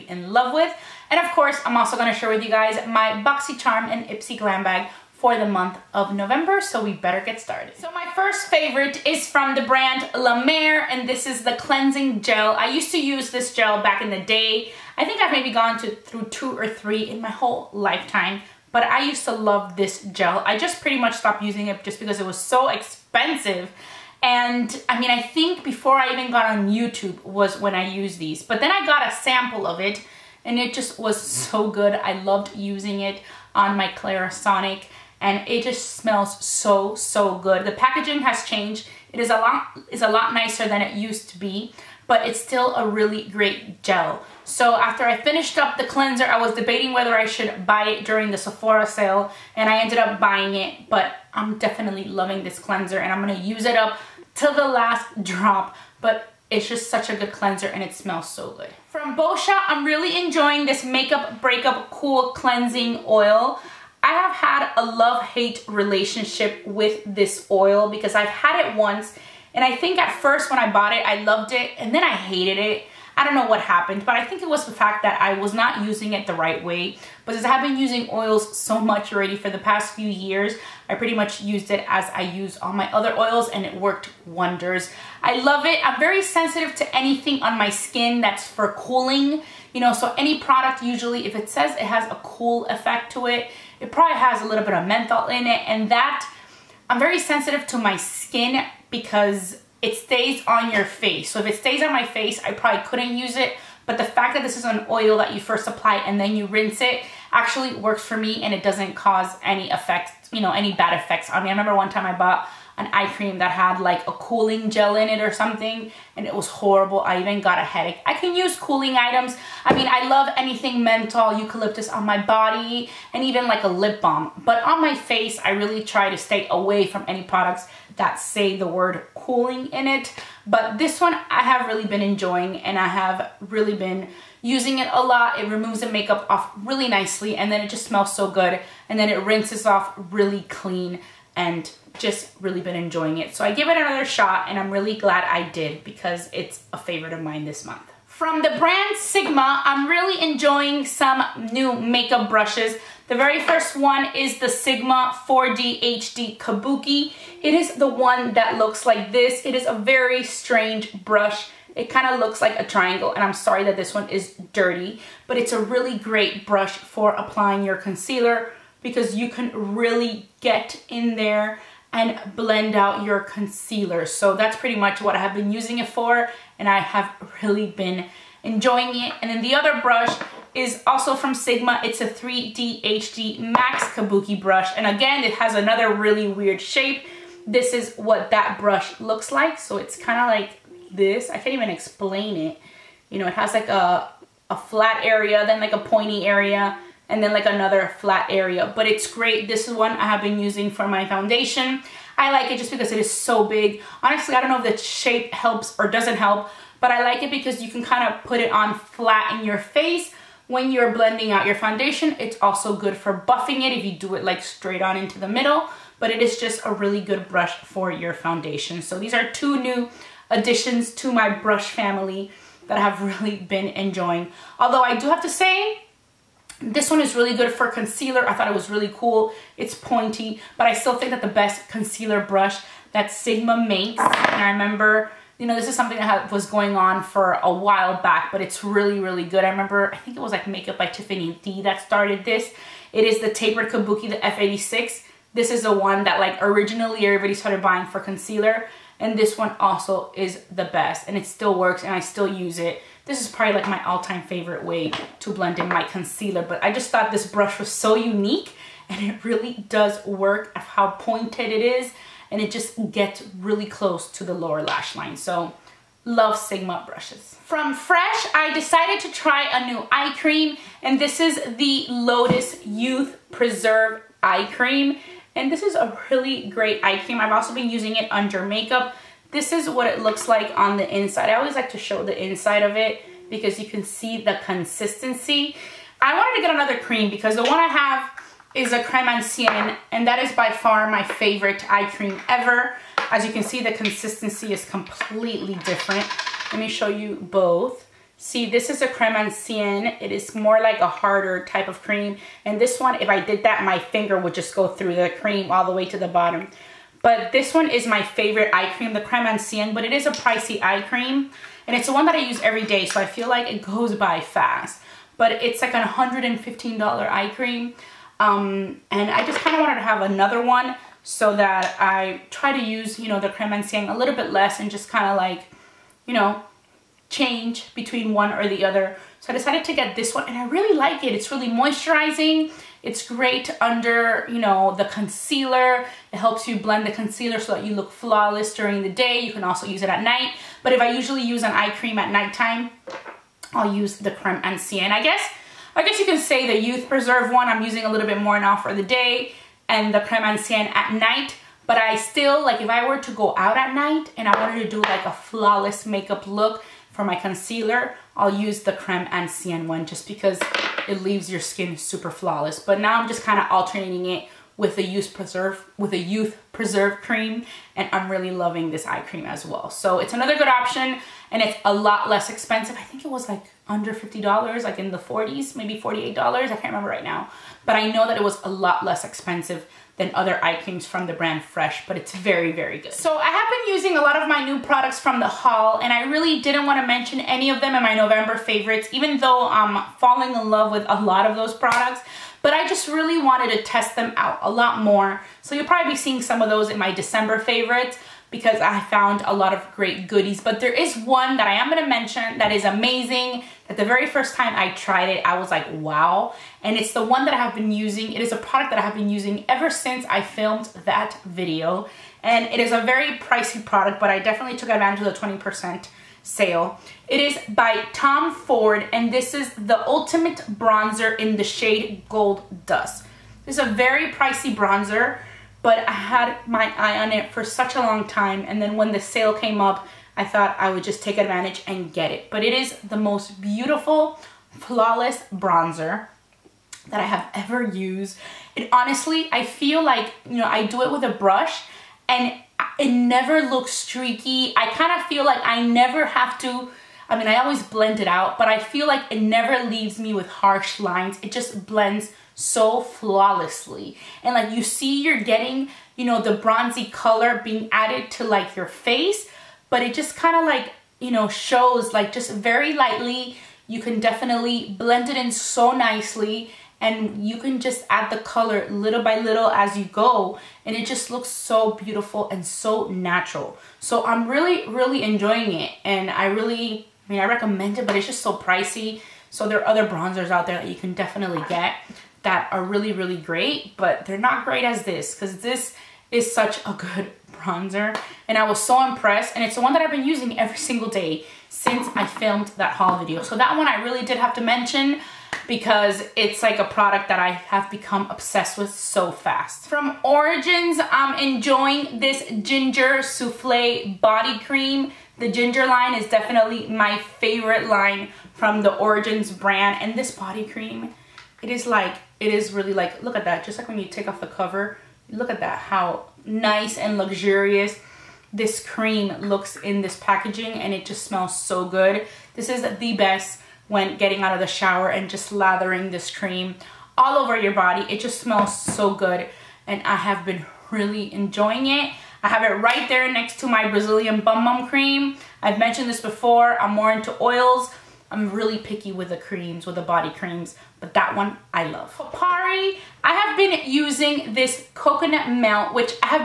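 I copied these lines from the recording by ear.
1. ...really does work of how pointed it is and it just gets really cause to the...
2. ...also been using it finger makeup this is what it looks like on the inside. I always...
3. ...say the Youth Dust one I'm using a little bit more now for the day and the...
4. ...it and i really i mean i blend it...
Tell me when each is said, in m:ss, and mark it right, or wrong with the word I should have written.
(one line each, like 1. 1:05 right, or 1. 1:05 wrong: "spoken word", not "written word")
1. 4:19 wrong: "close", not "cause"
2. 4:37 wrong: "under", not "finger"
3. 5:46 wrong: "Preserve", not "Dust"
4. 7:55 wrong: "recommend", not "blend".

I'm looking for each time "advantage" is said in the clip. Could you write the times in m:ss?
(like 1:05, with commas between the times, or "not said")
6:54, 7:11.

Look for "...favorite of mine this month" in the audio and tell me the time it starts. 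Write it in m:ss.
2:26.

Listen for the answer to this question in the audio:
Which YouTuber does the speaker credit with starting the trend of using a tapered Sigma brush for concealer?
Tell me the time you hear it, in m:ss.
4:00.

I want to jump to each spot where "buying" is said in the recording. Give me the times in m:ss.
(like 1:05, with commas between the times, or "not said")
0:50, 4:07.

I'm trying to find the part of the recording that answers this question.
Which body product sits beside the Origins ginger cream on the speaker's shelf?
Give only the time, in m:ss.
8:53.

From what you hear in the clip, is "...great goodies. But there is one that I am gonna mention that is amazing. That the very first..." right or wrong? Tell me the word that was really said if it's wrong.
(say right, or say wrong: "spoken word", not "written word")
right.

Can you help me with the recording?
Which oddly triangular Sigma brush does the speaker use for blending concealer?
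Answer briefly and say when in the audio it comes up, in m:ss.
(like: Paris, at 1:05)
4D HD Kabuki, at 2:35.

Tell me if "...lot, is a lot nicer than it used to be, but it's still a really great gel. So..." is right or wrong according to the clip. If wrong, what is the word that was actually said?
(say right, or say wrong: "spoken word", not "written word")
right.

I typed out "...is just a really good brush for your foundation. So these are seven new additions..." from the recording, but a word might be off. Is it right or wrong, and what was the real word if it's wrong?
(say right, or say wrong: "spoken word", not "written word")
wrong: "two", not "seven".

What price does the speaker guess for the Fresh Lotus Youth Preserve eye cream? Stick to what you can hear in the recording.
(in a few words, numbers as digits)
$48.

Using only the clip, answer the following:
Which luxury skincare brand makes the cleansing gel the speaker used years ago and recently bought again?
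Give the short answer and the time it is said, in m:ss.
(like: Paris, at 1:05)
La Mer, at 0:10.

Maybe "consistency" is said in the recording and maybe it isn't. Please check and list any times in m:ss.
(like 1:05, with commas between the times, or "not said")
4:44, 4:53.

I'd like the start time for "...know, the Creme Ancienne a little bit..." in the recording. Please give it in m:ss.
5:23.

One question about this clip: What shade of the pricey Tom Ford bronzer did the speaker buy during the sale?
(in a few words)
Gold Dust.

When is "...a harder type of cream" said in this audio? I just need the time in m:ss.
5:00.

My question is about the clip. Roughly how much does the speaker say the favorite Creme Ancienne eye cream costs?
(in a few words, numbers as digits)
$115.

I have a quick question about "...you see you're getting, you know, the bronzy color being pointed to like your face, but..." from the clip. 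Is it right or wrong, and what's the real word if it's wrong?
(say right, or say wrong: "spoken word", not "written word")
wrong: "added", not "pointed".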